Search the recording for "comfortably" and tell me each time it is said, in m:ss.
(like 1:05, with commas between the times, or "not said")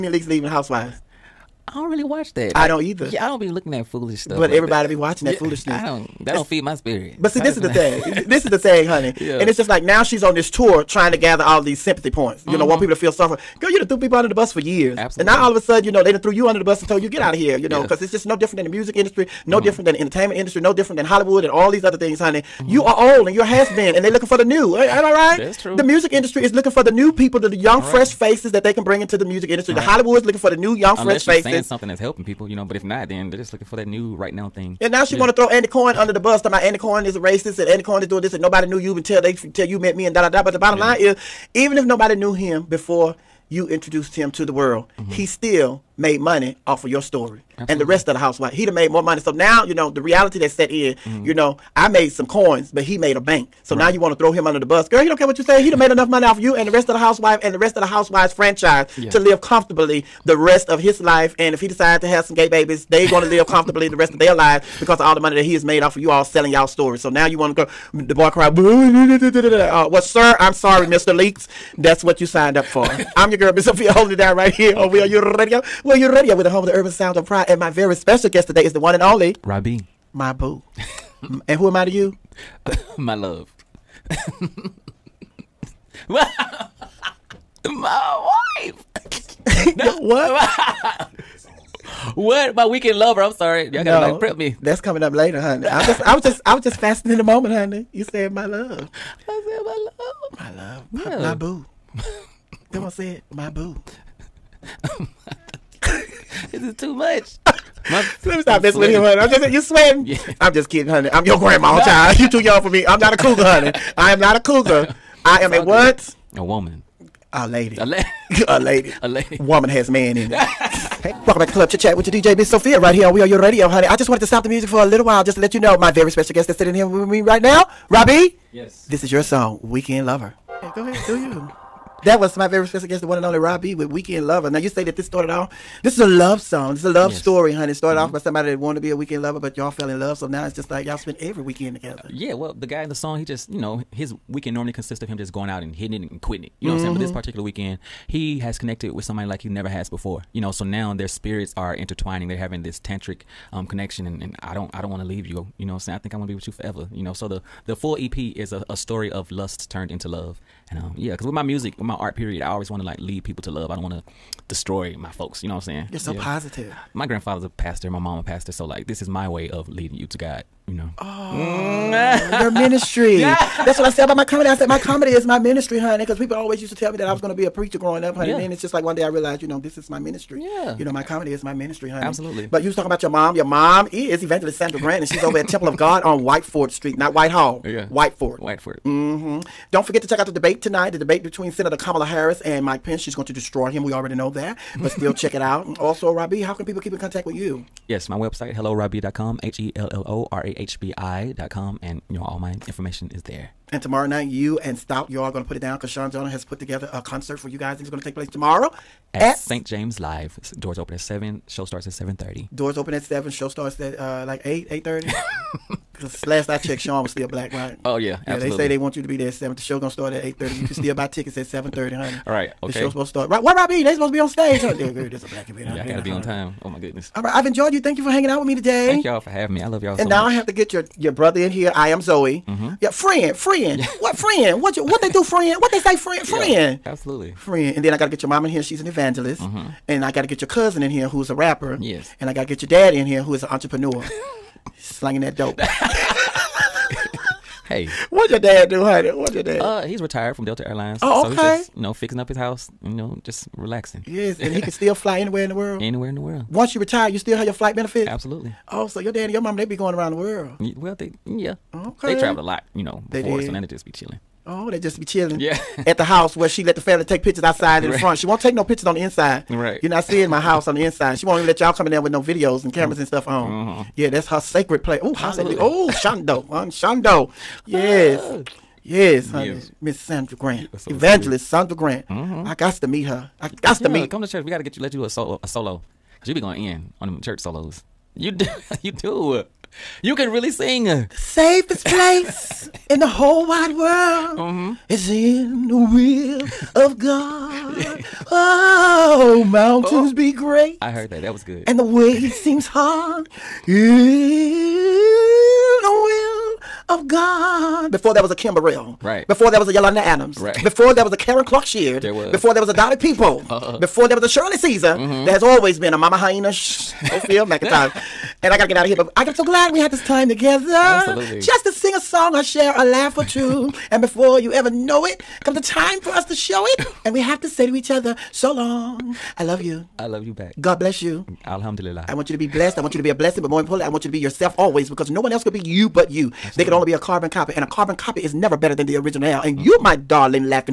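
0:59, 1:03.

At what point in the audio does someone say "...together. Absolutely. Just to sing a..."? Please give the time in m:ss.
5:20.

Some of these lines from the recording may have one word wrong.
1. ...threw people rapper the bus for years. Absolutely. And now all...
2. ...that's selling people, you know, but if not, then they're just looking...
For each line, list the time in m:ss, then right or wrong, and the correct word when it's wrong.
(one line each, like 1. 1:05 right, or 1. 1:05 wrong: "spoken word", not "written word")
1. 0:13 wrong: "under", not "rapper"
2. 0:31 wrong: "helping", not "selling".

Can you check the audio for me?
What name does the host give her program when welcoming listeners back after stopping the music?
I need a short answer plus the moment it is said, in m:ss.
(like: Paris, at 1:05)
Club Chit Chat, at 2:01.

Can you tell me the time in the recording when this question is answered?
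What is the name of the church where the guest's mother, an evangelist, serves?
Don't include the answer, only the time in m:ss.
3:05.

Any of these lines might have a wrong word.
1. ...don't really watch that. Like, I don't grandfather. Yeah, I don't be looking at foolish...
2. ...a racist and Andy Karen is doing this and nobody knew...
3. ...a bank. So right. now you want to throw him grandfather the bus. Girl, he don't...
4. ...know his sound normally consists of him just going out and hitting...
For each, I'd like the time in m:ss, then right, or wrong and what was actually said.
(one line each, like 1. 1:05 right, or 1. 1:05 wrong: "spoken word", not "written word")
1. 0:01 wrong: "either", not "grandfather"
2. 0:37 wrong: "Cohen", not "Karen"
3. 0:53 wrong: "under", not "grandfather"
4. 2:23 wrong: "weekend", not "sound".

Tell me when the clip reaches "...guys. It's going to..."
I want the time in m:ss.
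3:27.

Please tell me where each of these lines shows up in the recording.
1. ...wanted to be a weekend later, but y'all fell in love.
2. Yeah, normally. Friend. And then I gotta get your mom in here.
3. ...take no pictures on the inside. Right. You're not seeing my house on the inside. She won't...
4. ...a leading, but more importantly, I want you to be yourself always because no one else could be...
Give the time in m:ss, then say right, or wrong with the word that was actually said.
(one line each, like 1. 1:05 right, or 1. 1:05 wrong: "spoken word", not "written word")
1. 2:18 wrong: "lover", not "later"
2. 3:56 wrong: "absolutely", not "normally"
3. 4:28 right
4. 5:33 wrong: "blessing", not "leading".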